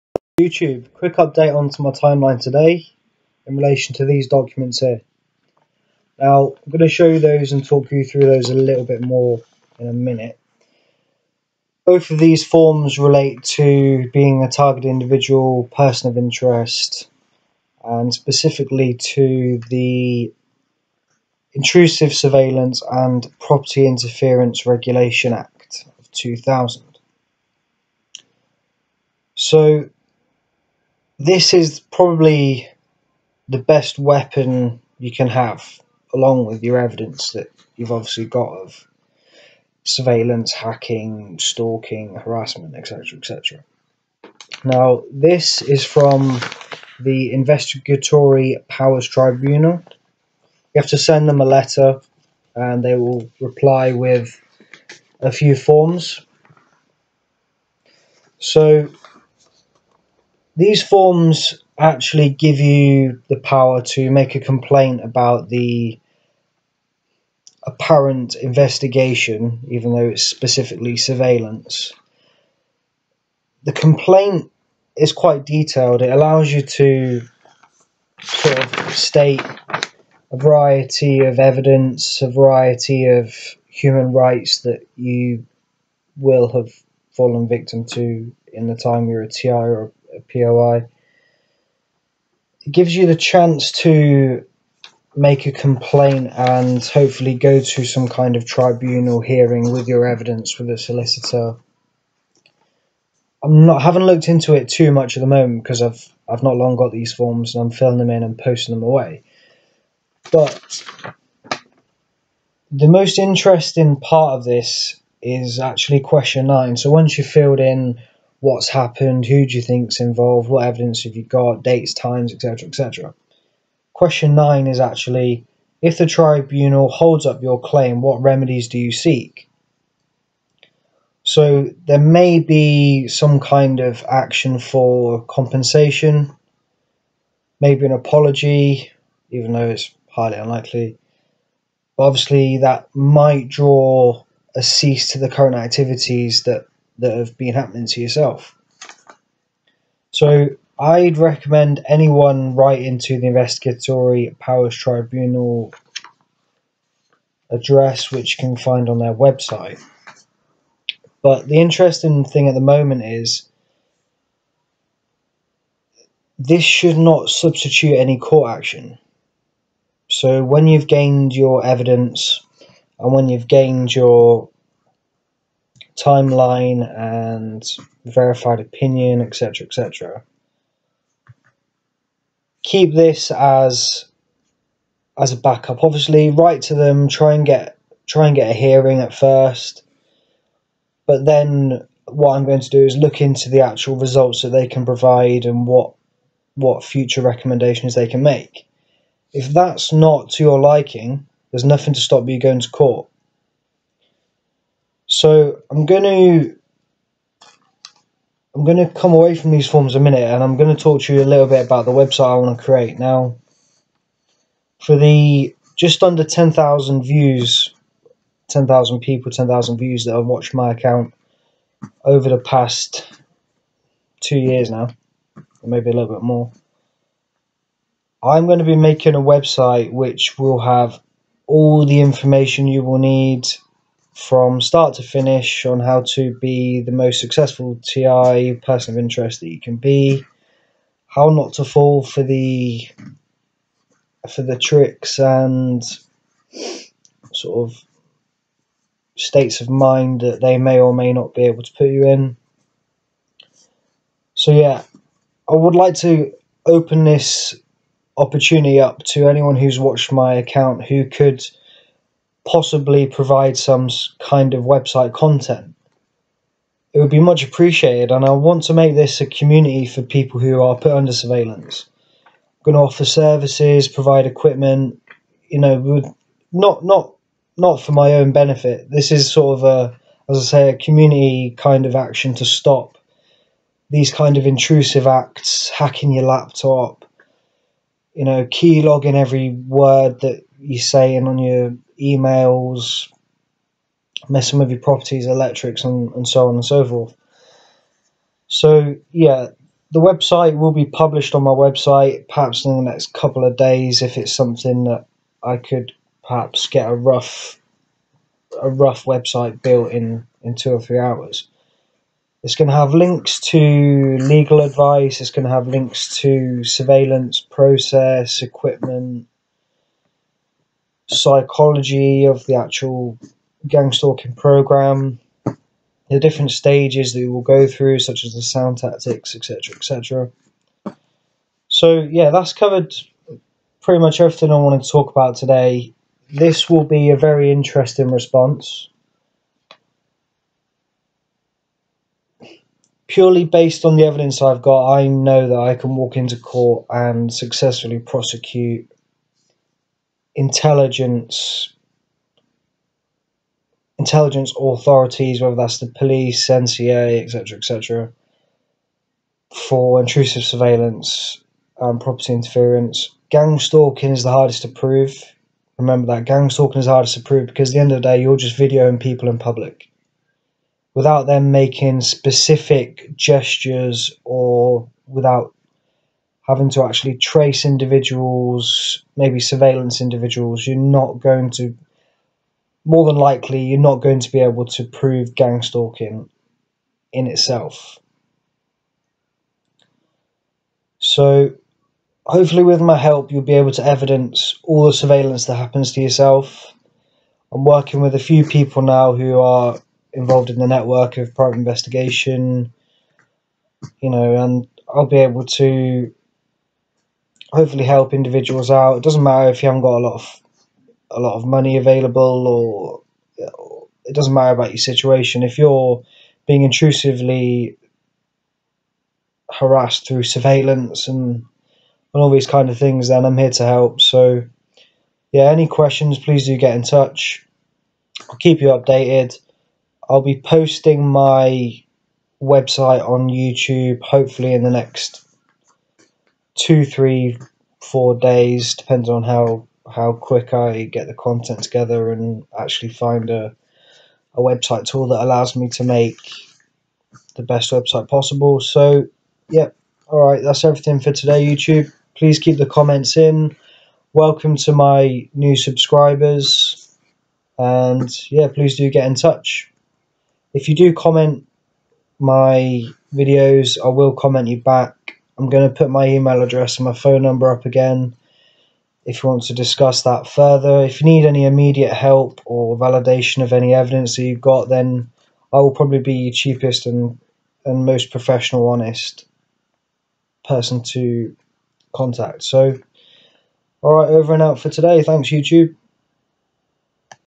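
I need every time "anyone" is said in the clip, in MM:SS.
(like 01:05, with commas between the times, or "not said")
02:31, 04:19.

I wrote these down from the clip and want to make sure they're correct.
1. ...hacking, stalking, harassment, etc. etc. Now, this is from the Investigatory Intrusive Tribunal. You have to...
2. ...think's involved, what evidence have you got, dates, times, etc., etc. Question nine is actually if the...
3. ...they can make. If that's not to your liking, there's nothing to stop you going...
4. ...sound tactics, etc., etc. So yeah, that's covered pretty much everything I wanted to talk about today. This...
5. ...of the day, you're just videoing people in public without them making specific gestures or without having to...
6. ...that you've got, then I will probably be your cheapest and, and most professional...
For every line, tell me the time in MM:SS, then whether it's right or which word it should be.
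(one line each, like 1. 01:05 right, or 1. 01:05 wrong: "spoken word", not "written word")
1. 00:40 wrong: "Powers", not "Intrusive"
2. 01:59 right
3. 03:17 right
4. 05:28 right
5. 06:07 right
6. 07:54 right.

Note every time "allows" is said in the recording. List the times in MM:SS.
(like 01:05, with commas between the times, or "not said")
01:16, 07:25.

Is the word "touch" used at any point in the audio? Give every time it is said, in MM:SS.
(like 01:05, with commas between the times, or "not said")
07:06, 07:39.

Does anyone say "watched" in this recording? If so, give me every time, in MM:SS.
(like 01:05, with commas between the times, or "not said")
03:40, 04:19.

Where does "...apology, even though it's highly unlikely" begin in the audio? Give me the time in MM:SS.
02:17.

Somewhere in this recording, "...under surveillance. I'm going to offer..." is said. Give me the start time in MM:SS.
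04:30.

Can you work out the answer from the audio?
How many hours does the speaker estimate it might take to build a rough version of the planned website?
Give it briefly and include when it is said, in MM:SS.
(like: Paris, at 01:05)
2 or 3, at 05:10.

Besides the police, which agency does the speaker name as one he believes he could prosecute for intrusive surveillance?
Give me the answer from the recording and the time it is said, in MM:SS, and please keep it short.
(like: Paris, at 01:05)
NCA, at 05:56.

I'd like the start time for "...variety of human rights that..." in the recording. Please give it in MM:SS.
01:22.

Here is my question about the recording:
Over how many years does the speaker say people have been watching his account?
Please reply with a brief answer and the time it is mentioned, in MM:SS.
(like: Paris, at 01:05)
2, at 03:44.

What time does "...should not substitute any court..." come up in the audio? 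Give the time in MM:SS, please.
02:46.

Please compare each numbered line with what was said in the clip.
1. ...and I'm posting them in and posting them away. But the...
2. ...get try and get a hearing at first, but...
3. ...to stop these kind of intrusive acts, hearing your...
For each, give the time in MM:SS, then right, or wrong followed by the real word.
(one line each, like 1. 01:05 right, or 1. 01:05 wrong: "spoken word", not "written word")
1. 01:47 wrong: "filling", not "posting"
2. 03:07 right
3. 04:42 wrong: "hacking", not "hearing".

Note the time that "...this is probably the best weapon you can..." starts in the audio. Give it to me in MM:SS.
00:31.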